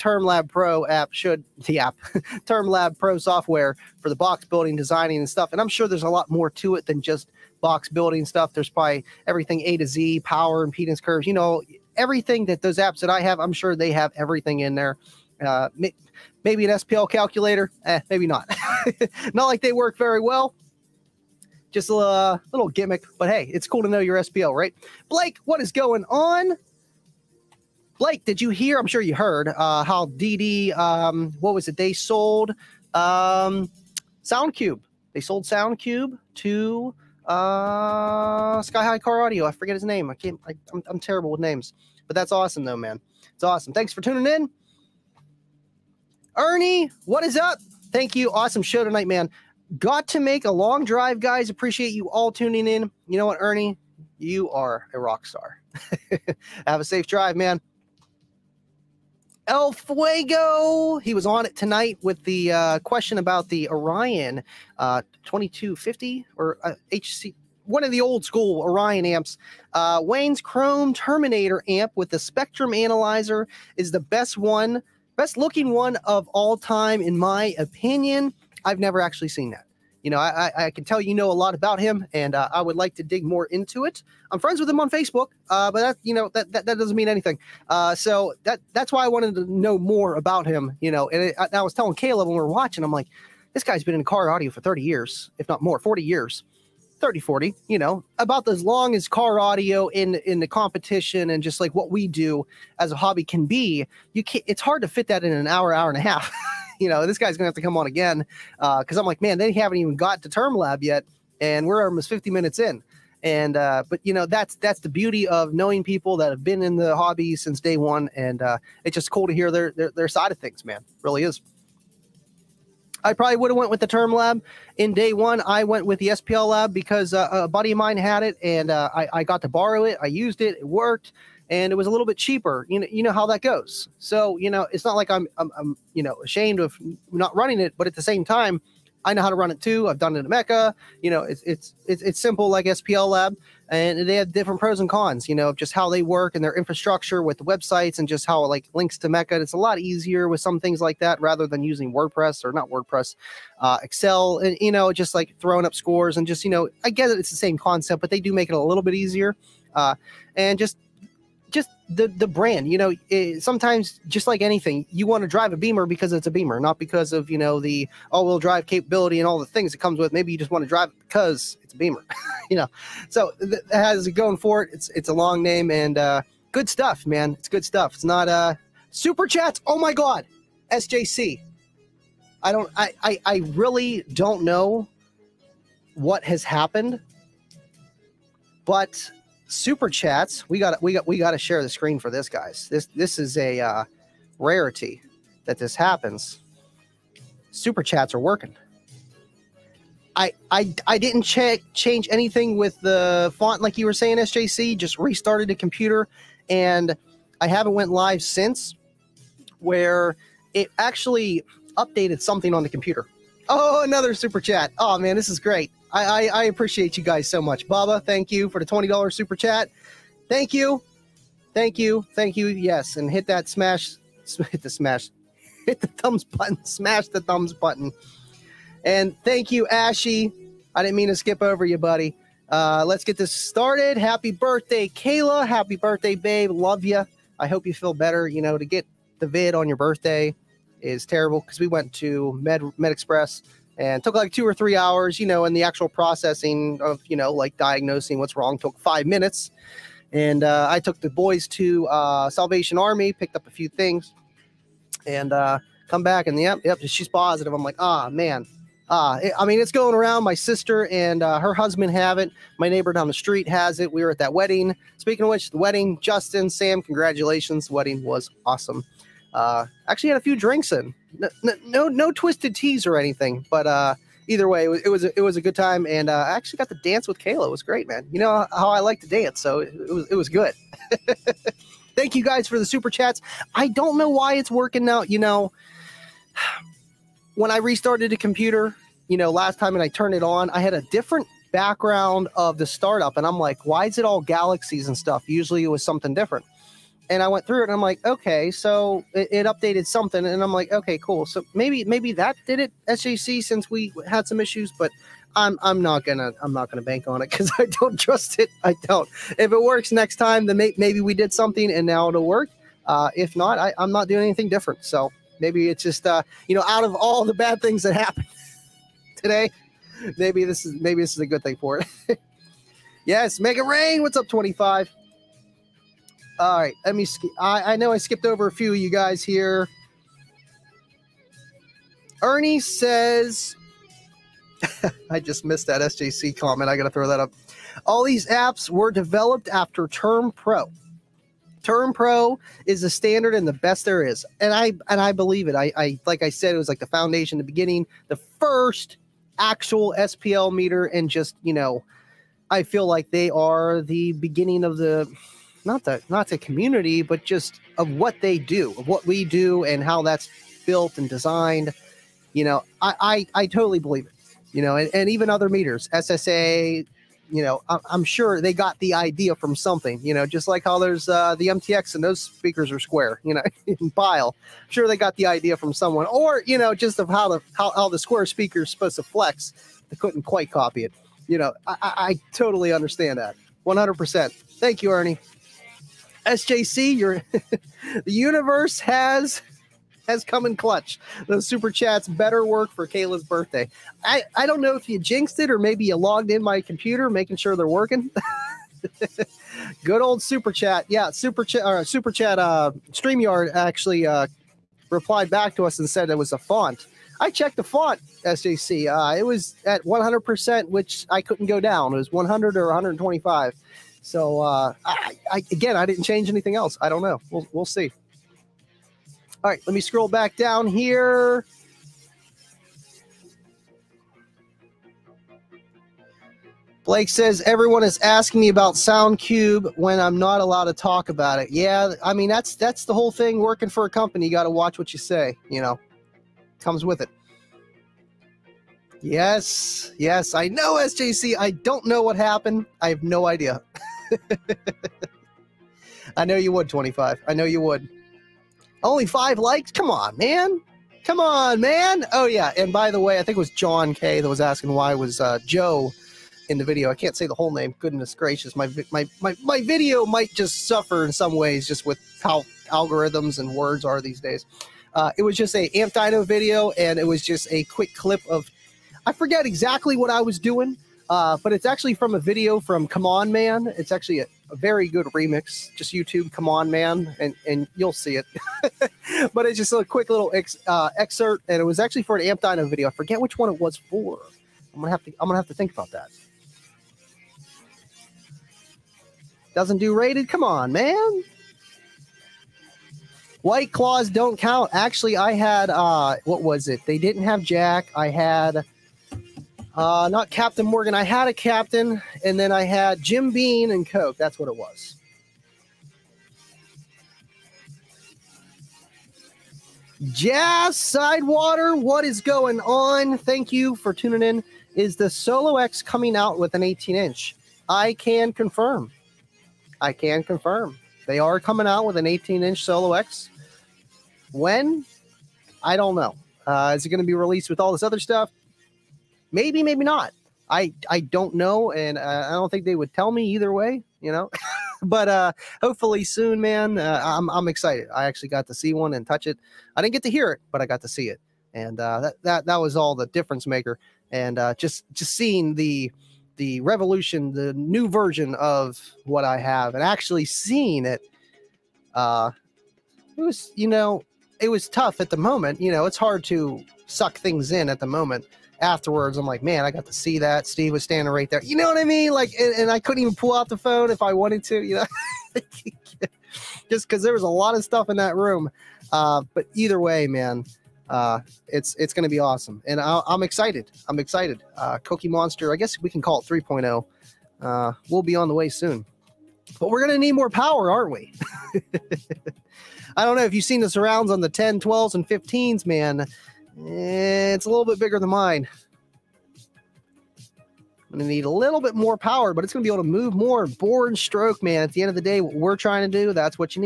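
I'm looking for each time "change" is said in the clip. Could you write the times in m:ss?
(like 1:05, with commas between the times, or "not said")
3:21, 6:56.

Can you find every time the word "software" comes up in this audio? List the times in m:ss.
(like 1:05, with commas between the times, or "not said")
0:03.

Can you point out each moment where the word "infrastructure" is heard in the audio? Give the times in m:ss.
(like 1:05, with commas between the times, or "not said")
2:26.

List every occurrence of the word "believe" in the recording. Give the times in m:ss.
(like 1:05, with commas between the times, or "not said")
5:45, 6:03.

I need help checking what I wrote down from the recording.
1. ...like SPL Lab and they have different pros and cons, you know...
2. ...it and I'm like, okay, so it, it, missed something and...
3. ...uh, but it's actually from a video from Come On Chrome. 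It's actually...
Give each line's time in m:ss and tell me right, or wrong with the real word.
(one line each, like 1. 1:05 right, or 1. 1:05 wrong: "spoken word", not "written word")
1. 2:22 right
2. 4:57 wrong: "updated", not "missed"
3. 7:51 wrong: "Man", not "Chrome".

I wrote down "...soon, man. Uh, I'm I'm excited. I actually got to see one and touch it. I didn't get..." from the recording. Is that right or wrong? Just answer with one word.
right.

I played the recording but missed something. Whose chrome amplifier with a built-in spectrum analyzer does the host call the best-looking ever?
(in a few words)
Wayne's.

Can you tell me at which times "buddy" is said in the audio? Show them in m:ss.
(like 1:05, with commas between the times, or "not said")
2:07, 3:51.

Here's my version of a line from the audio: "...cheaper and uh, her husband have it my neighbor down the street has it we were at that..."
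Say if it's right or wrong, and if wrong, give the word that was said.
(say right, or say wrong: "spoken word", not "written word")
wrong: "sister", not "cheaper".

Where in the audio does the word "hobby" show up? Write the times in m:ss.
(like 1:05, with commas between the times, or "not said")
1:42, 1:56.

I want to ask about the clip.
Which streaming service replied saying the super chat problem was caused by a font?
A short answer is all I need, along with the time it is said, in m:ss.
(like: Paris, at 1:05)
StreamYard, at 6:42.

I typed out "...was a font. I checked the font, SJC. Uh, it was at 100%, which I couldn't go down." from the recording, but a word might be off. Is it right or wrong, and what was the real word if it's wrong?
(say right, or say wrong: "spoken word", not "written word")
right.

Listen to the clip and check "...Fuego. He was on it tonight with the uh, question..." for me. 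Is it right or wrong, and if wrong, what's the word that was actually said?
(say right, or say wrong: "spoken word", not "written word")
right.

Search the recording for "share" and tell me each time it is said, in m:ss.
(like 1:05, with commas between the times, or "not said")
3:11.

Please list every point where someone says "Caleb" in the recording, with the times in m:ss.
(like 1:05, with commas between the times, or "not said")
1:31.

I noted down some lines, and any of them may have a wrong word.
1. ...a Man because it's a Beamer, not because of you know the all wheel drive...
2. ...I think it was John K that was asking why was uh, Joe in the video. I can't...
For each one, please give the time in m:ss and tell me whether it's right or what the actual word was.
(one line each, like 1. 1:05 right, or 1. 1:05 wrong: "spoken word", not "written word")
1. 2:45 wrong: "Beamer", not "Man"
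2. 7:33 right.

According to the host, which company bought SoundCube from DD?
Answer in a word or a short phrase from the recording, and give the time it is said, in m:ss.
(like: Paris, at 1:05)
Sky High Car Audio, at 0:38.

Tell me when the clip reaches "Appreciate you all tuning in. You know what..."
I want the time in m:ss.
0:51.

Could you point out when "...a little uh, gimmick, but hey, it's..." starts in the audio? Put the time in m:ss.
0:21.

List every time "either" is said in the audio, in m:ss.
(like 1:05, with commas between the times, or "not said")
4:34, 8:53, 9:29.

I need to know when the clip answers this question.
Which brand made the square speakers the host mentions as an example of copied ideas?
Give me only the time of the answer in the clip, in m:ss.
6:11.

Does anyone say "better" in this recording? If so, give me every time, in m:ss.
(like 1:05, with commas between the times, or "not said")
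3:57, 6:32.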